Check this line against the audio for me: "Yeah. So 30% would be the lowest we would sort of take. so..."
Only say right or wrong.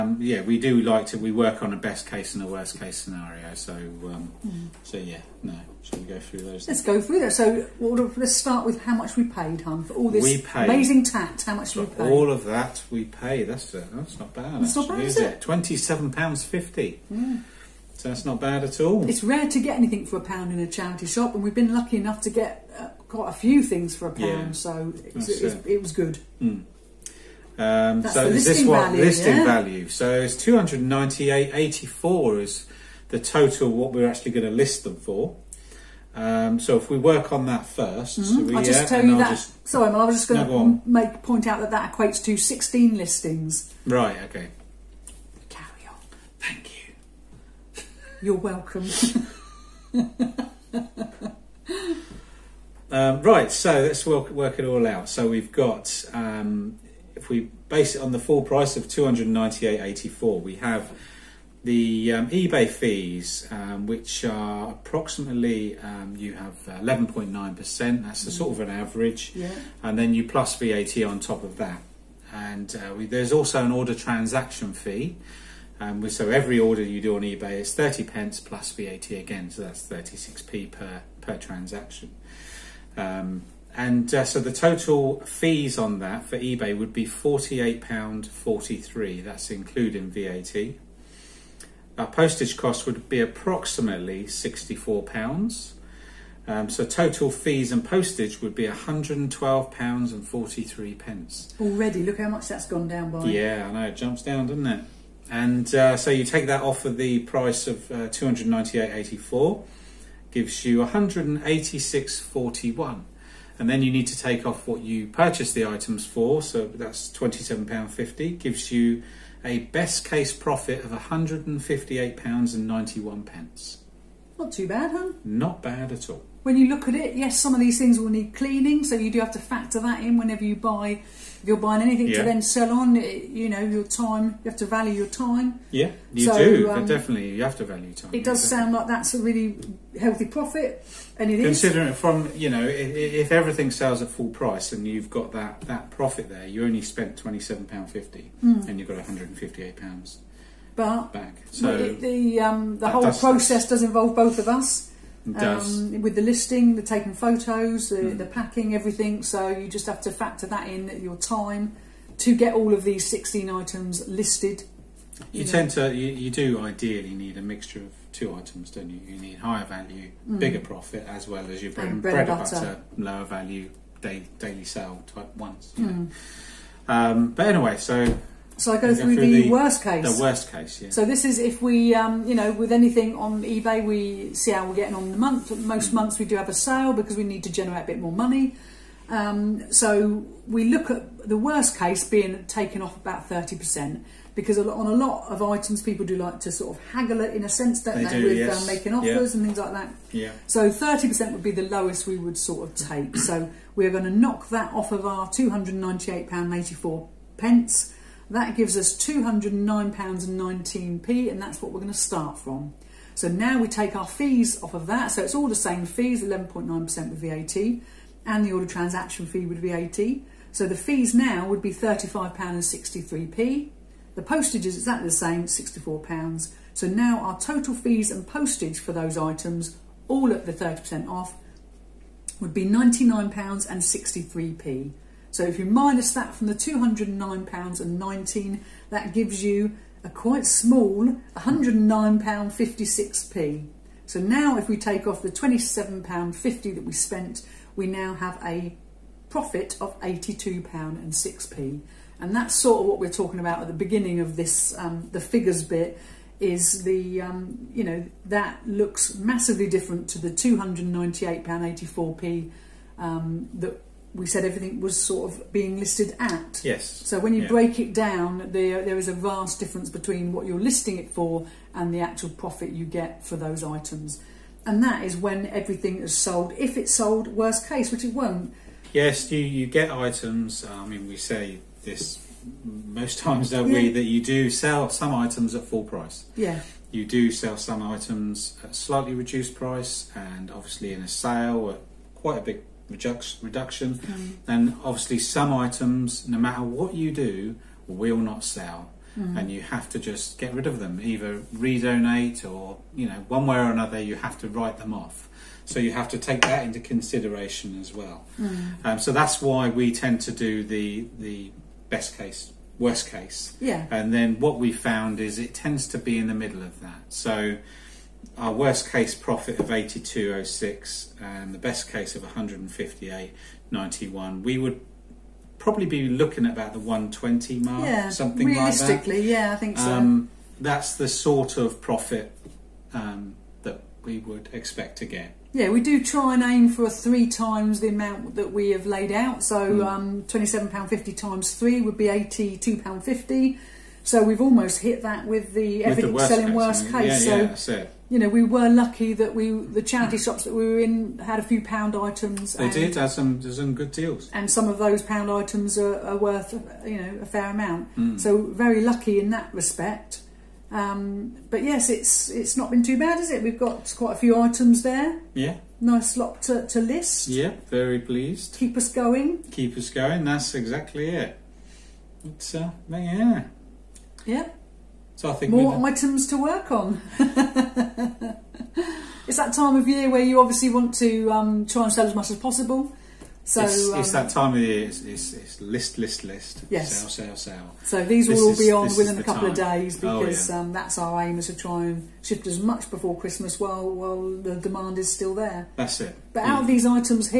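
right.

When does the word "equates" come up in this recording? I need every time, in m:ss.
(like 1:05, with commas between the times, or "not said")
0:41.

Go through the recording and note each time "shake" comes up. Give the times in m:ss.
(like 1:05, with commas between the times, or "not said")
not said.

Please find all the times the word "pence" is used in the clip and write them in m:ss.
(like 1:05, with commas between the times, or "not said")
1:18, 3:27.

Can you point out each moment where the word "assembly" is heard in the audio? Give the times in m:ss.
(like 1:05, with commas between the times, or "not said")
not said.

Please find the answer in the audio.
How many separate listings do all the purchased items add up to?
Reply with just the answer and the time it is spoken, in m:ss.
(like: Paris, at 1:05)
16, at 0:42.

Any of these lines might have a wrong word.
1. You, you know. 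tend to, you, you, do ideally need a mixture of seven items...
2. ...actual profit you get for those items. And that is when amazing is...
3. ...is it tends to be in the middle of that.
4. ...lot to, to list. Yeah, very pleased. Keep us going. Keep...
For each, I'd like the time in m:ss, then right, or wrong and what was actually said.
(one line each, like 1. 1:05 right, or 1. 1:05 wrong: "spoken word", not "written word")
1. 2:45 wrong: "two", not "seven"
2. 4:31 wrong: "everything", not "amazing"
3. 5:15 right
4. 6:06 right.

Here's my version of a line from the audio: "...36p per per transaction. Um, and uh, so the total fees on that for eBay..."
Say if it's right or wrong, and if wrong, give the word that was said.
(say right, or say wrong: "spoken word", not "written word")
right.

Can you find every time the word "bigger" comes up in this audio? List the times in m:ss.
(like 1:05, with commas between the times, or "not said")
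2:50.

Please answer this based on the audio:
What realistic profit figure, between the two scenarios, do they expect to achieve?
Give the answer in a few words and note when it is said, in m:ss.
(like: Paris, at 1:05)
about £120, at 5:26.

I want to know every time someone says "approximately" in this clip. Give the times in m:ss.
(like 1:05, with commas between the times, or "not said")
1:04, 1:33.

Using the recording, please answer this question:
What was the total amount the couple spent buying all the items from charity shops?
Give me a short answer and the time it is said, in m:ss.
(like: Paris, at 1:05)
£27.50, at 0:15.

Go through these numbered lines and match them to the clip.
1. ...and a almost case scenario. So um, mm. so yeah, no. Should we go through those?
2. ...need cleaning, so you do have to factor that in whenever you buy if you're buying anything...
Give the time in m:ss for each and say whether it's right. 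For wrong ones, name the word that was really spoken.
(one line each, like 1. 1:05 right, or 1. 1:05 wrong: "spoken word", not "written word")
1. 0:02 wrong: "worst", not "almost"
2. 2:08 right.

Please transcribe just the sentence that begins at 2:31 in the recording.
So the, the, um, the whole does process does involve both of us.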